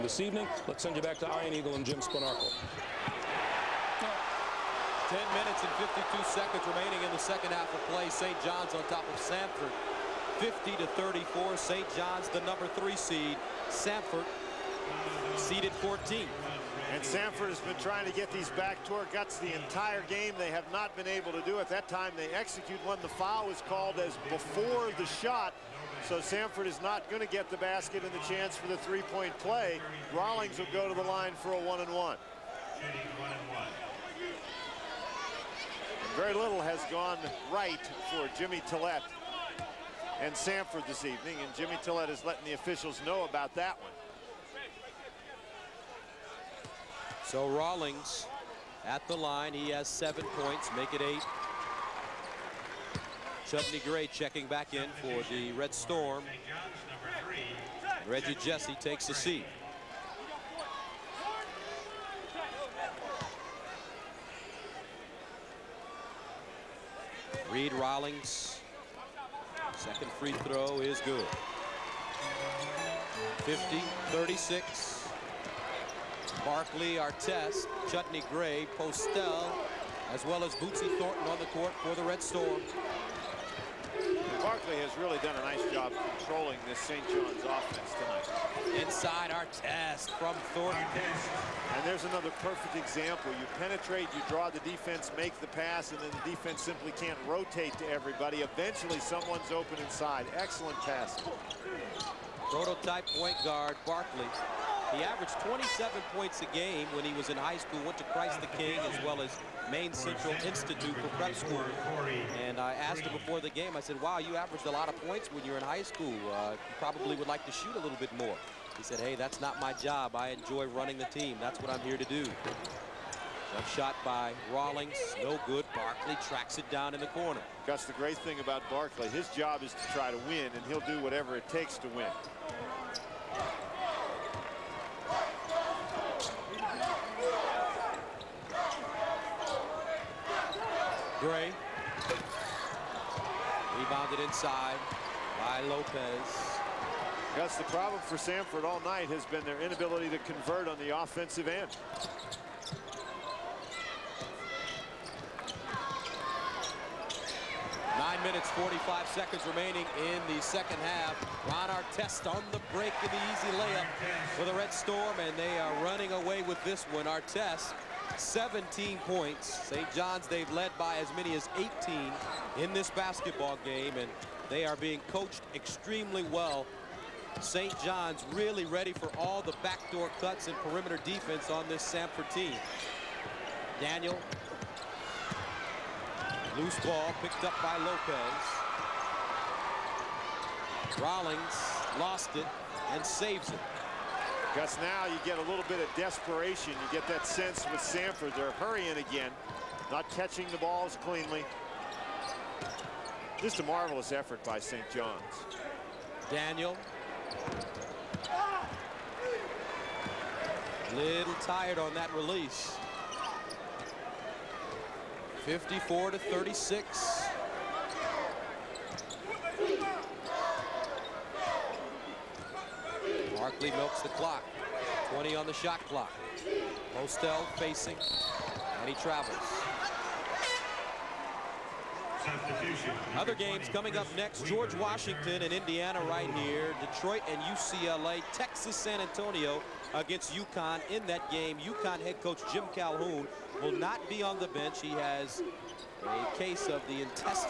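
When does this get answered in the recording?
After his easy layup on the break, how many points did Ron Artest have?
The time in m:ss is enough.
2:47.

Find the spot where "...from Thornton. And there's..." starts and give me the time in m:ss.
1:30.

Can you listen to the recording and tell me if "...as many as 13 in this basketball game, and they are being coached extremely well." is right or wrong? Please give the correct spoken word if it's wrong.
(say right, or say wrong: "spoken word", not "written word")
wrong: "18", not "13".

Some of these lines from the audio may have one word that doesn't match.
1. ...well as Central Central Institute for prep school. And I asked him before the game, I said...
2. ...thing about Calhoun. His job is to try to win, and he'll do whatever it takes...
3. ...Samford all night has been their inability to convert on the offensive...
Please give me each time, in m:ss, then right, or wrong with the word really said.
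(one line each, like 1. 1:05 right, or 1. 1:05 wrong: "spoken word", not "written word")
1. 1:49 wrong: "Maine", not "Central"
2. 2:08 wrong: "Barkley", not "Calhoun"
3. 2:28 right.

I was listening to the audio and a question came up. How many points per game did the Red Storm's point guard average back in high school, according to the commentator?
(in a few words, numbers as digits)
27.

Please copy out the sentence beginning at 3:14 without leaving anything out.
Because now you get a little bit of desperation.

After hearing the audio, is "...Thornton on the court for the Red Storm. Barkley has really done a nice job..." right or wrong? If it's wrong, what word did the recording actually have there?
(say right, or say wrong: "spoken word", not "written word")
right.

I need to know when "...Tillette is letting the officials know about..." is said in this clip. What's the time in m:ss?
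0:41.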